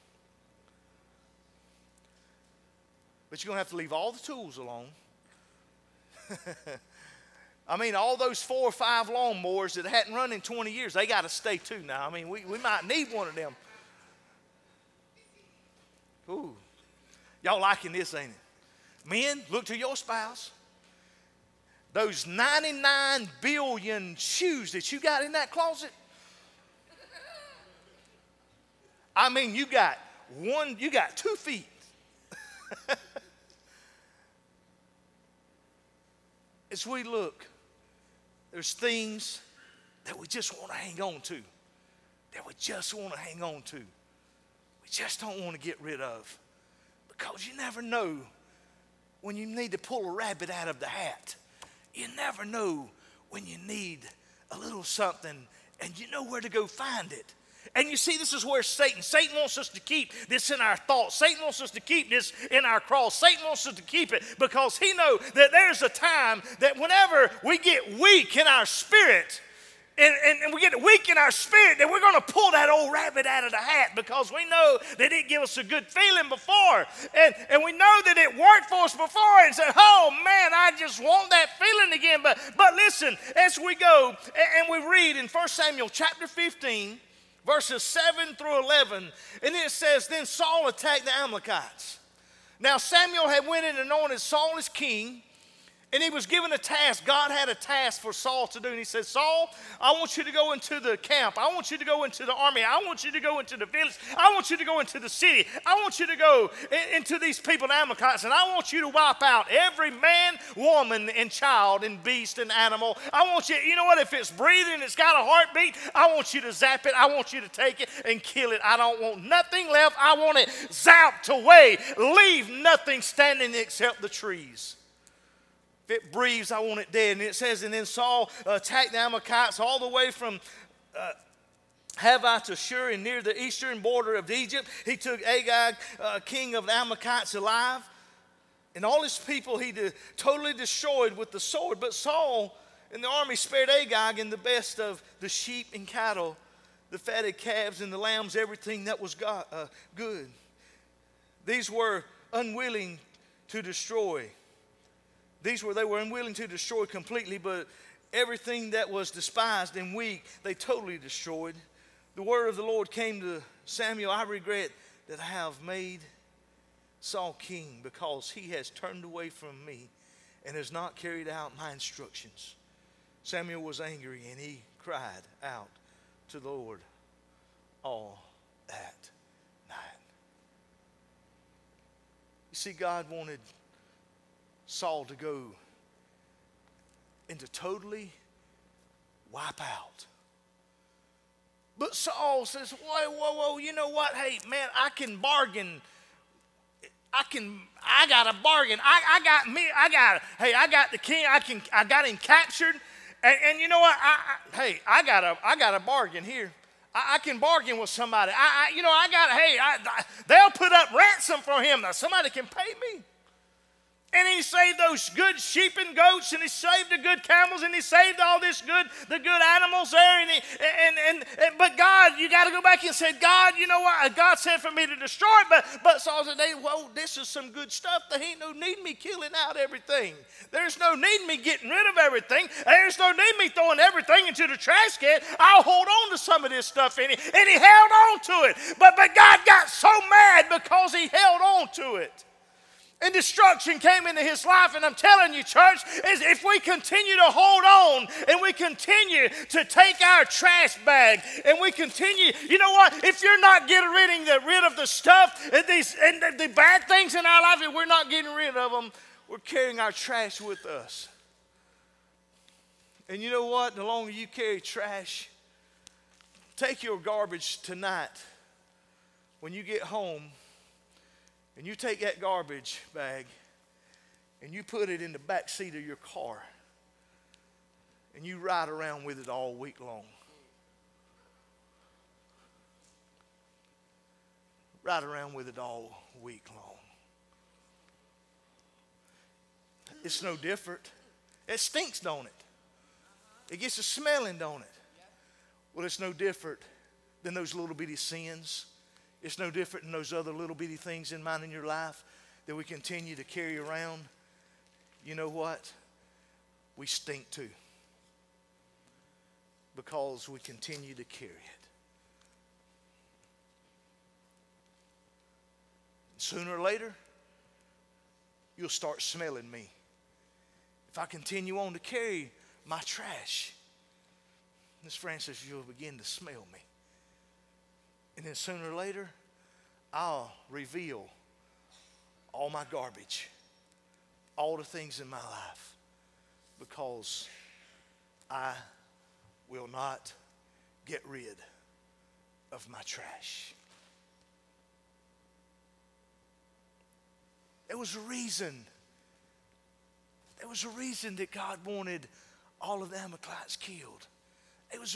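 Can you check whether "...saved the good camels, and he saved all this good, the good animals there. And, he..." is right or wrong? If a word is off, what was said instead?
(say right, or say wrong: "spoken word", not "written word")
right.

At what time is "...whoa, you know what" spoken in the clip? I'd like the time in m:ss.
3:13.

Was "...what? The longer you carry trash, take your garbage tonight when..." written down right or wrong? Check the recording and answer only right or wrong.
right.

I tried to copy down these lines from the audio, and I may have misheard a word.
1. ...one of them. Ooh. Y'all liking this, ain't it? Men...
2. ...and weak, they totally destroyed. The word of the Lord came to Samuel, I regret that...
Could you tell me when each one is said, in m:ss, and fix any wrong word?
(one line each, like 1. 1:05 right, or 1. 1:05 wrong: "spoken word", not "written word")
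1. 0:13 right
2. 2:39 right.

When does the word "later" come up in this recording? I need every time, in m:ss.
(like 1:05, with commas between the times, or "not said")
5:16, 5:28.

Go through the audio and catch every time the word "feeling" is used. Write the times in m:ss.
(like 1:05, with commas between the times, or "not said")
1:15, 1:21.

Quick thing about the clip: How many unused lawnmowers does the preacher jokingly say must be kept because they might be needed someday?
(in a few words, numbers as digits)
4 or 5.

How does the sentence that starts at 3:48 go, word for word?
There ain't no need me killing out everything.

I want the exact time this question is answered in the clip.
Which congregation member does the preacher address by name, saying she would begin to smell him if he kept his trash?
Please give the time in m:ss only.
5:24.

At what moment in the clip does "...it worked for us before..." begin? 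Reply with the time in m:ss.
1:18.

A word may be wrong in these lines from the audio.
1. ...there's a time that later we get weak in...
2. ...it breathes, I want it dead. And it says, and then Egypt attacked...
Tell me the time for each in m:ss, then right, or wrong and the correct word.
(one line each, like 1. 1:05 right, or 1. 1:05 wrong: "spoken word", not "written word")
1. 1:05 wrong: "whenever", not "later"
2. 2:05 wrong: "Saul", not "Egypt".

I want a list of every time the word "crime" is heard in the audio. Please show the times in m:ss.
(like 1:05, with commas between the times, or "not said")
not said.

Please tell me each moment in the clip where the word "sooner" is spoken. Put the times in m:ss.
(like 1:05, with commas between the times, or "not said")
5:16, 5:28.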